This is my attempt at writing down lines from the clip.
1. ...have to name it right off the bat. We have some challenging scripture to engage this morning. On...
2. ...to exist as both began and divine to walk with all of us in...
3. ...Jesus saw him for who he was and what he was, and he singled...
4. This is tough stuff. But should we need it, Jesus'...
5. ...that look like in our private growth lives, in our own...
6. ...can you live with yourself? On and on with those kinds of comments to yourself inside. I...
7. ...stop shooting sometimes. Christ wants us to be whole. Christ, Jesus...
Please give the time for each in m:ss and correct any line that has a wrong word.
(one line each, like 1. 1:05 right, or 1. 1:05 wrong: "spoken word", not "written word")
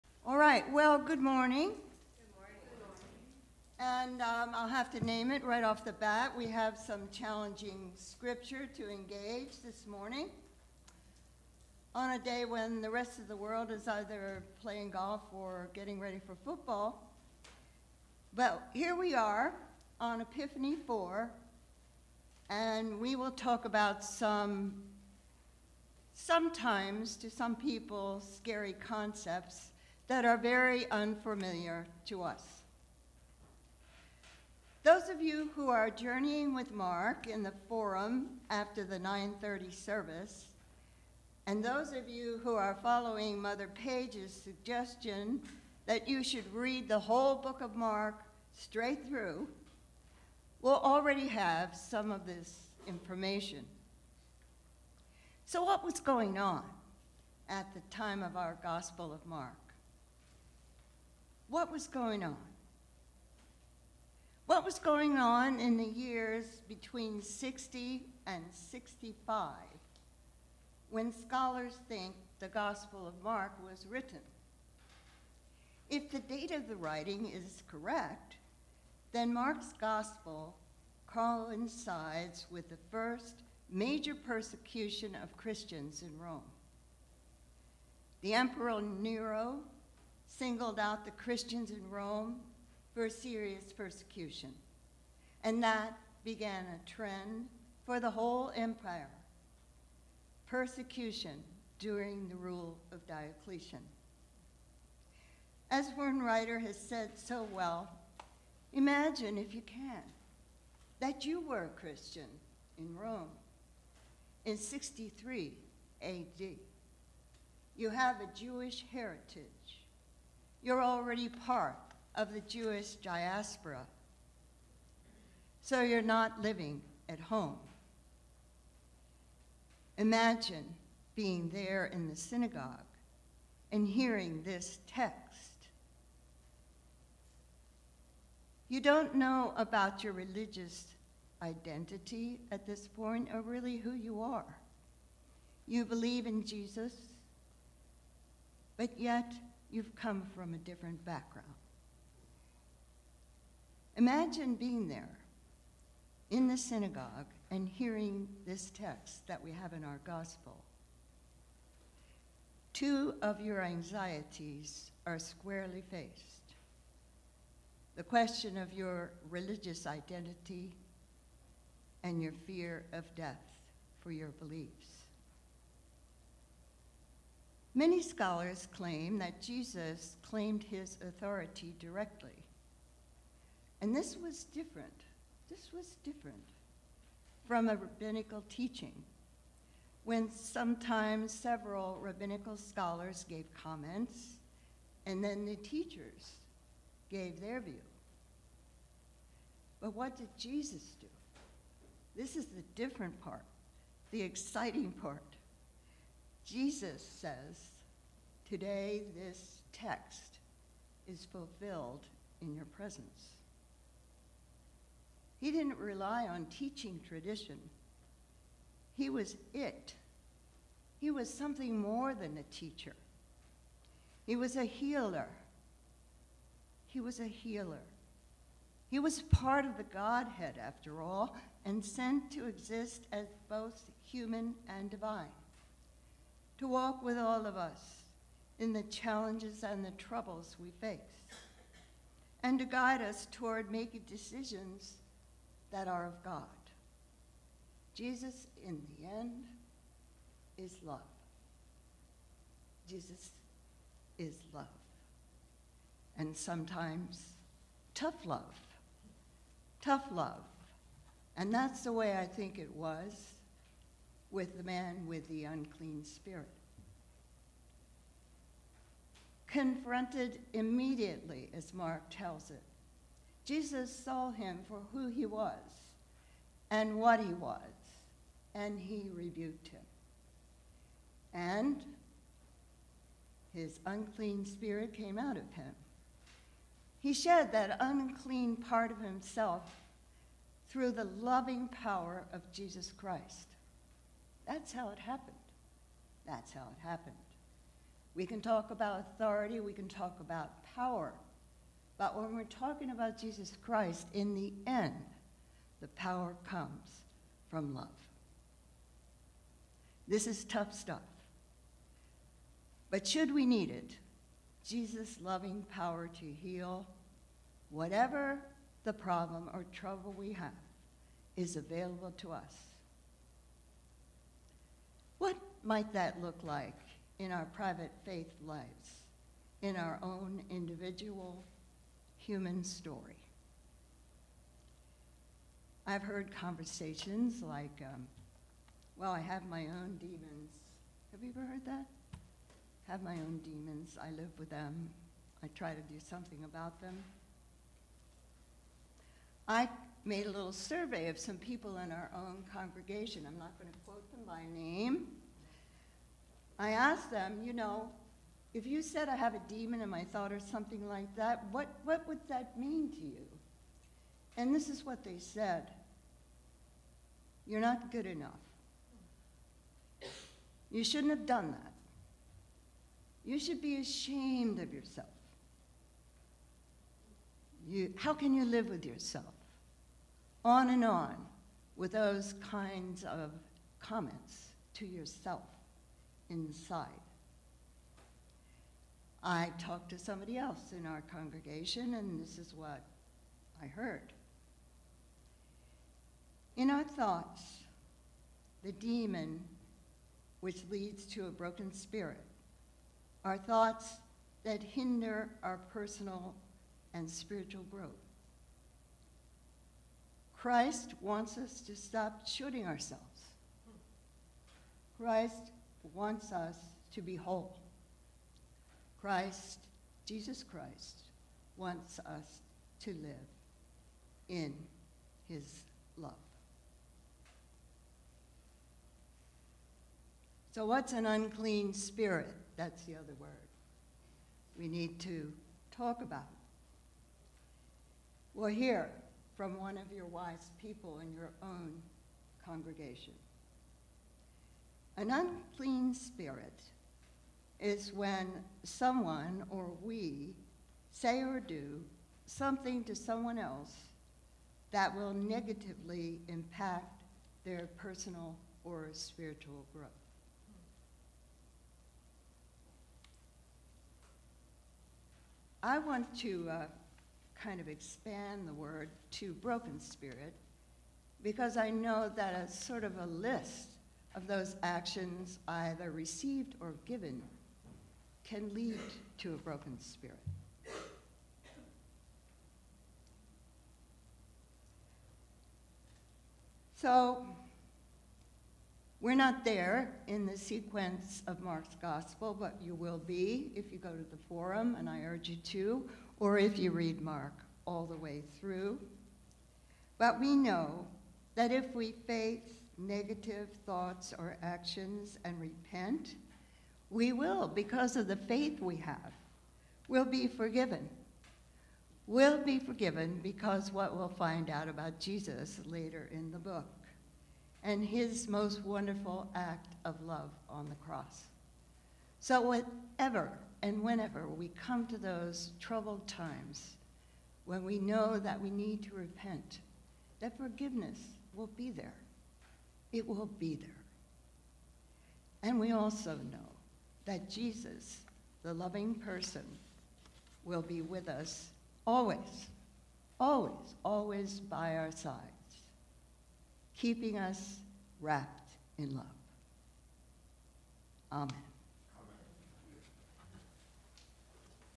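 1. 0:04 right
2. 3:52 wrong: "human", not "began"
3. 4:33 wrong: "rebuked", not "singled"
4. 5:10 right
5. 5:25 wrong: "faith", not "growth"
6. 6:18 right
7. 6:51 wrong: "ourselves", not "sometimes".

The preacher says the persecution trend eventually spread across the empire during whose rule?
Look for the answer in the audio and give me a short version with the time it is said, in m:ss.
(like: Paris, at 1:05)
Diocletian, at 1:43.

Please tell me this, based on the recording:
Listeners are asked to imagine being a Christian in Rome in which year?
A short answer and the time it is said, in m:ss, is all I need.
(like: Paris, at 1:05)
63 AD, at 1:54.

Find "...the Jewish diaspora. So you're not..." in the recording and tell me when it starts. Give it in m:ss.
2:02.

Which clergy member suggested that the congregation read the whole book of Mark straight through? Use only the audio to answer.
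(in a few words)
Mother Page.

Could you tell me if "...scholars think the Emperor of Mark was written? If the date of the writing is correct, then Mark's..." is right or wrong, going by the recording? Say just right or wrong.
wrong.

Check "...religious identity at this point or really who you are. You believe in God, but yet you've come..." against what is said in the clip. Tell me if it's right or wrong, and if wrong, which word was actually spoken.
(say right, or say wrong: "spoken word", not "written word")
wrong: "Jesus", not "God".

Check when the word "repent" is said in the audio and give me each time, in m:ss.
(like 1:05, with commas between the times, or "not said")
8:25, 8:48.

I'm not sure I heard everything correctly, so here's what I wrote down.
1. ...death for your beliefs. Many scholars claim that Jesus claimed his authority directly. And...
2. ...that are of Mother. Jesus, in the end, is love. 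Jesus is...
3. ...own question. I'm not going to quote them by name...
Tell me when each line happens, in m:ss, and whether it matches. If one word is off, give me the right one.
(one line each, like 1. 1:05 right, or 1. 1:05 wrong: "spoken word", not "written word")
1. 2:53 right
2. 4:05 wrong: "God", not "Mother"
3. 5:52 wrong: "congregation", not "question".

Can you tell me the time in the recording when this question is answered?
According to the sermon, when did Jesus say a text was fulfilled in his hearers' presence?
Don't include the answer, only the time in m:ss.
3:28.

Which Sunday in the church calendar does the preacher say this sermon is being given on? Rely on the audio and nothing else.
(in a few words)
Epiphany 4.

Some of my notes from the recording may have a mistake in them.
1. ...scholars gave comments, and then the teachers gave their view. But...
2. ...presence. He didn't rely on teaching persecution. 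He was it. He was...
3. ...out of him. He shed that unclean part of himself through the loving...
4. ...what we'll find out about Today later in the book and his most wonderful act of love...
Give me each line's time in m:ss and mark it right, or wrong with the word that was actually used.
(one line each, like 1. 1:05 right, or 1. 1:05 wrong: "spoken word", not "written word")
1. 3:12 right
2. 3:32 wrong: "tradition", not "persecution"
3. 4:45 right
4. 8:33 wrong: "Jesus", not "Today".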